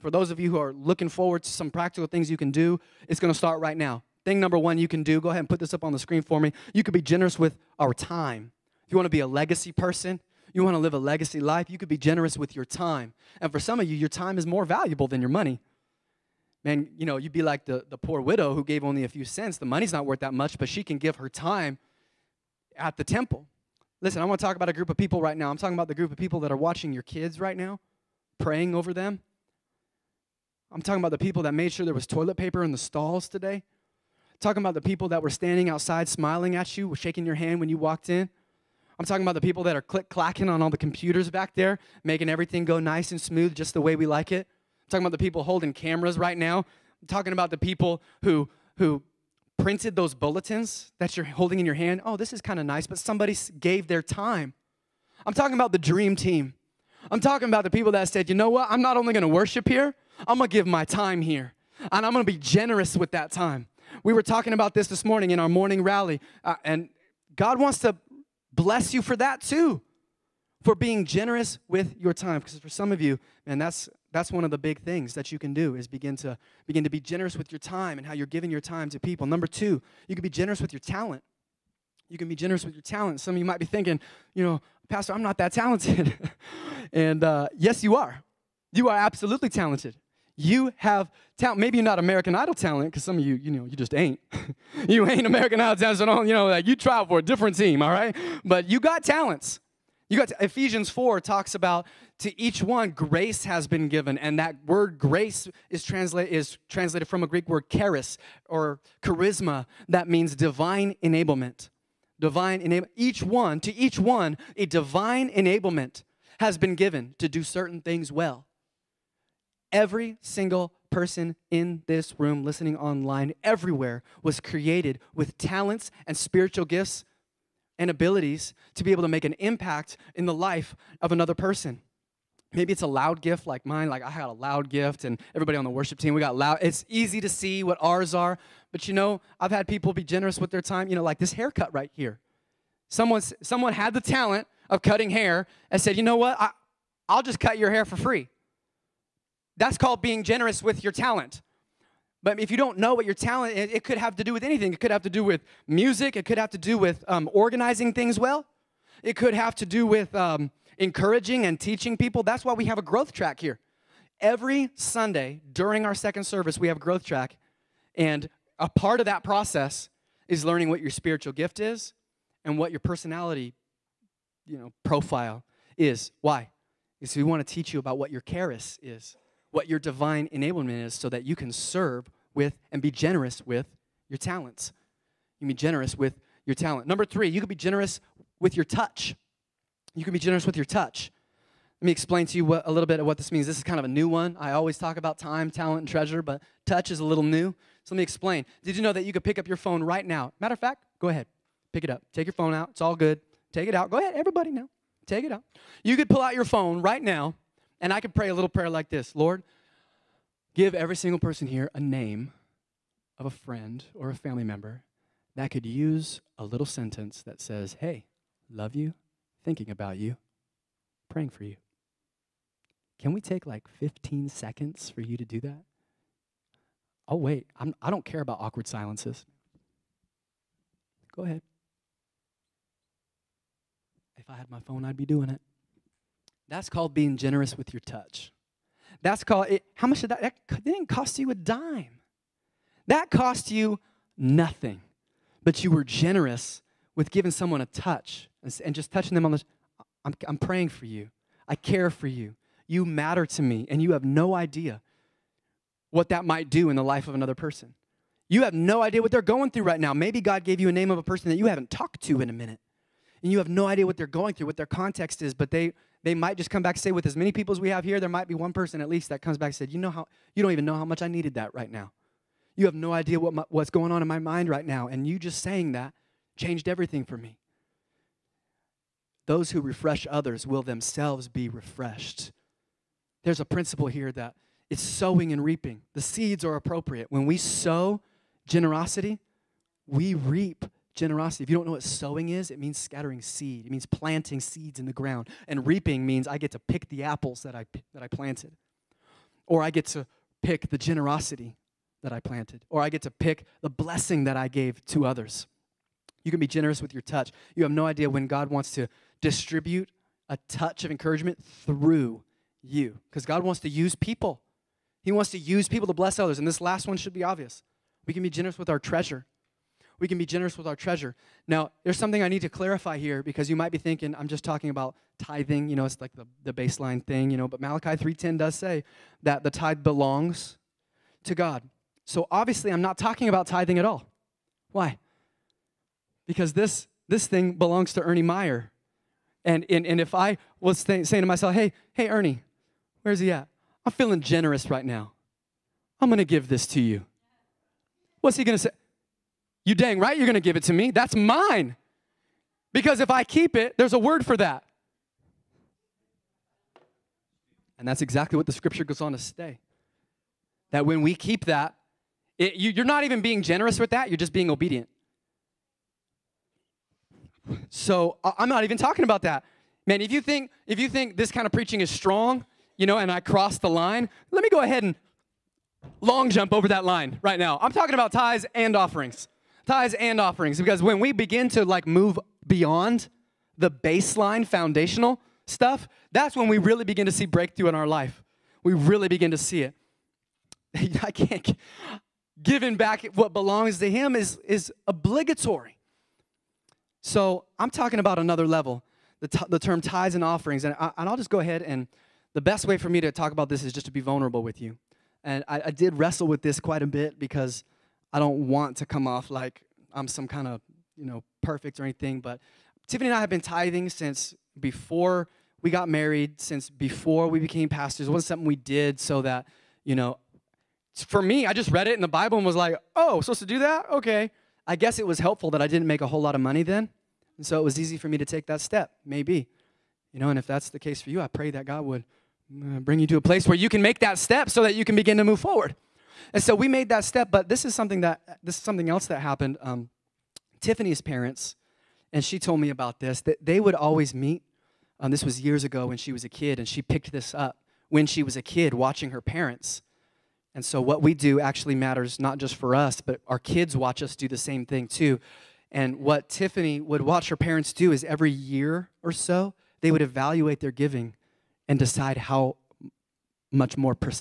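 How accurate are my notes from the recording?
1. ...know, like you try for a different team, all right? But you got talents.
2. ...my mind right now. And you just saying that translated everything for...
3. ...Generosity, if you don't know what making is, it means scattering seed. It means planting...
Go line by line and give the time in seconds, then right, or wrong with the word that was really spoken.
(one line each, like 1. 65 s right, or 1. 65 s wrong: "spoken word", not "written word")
1. 96 s right
2. 274 s wrong: "changed", not "translated"
3. 290 s wrong: "sowing", not "making".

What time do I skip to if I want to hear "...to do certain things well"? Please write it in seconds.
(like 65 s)
117 s.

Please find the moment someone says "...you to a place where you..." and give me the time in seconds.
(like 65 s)
432 s.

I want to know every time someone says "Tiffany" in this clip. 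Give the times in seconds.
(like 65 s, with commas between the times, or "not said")
412 s, 440 s, 456 s.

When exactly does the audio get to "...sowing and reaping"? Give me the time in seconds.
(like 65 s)
284 s.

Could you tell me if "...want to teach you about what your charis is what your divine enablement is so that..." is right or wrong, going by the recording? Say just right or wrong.
right.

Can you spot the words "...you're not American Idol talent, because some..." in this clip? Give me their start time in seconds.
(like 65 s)
91 s.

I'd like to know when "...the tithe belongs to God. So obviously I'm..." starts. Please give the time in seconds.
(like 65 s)
329 s.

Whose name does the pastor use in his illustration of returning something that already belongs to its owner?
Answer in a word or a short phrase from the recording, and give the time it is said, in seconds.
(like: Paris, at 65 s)
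Ernie Meyer, at 338 s.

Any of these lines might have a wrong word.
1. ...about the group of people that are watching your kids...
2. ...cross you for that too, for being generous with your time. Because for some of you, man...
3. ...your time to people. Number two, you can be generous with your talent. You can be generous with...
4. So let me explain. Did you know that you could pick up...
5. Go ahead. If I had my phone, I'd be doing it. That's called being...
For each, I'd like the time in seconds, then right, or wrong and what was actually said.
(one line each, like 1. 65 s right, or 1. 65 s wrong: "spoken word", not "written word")
1. 25 s right
2. 68 s wrong: "bless", not "cross"
3. 78 s right
4. 197 s right
5. 231 s right.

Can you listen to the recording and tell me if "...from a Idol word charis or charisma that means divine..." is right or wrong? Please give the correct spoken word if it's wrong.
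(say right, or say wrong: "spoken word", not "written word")
wrong: "Greek", not "Idol".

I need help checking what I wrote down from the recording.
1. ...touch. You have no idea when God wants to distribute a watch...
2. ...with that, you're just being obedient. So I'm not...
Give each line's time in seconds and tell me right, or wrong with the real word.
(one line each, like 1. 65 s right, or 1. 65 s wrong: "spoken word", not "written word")
1. 307 s wrong: "touch", not "watch"
2. 363 s right.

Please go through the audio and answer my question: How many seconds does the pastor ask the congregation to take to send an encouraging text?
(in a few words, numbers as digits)
15.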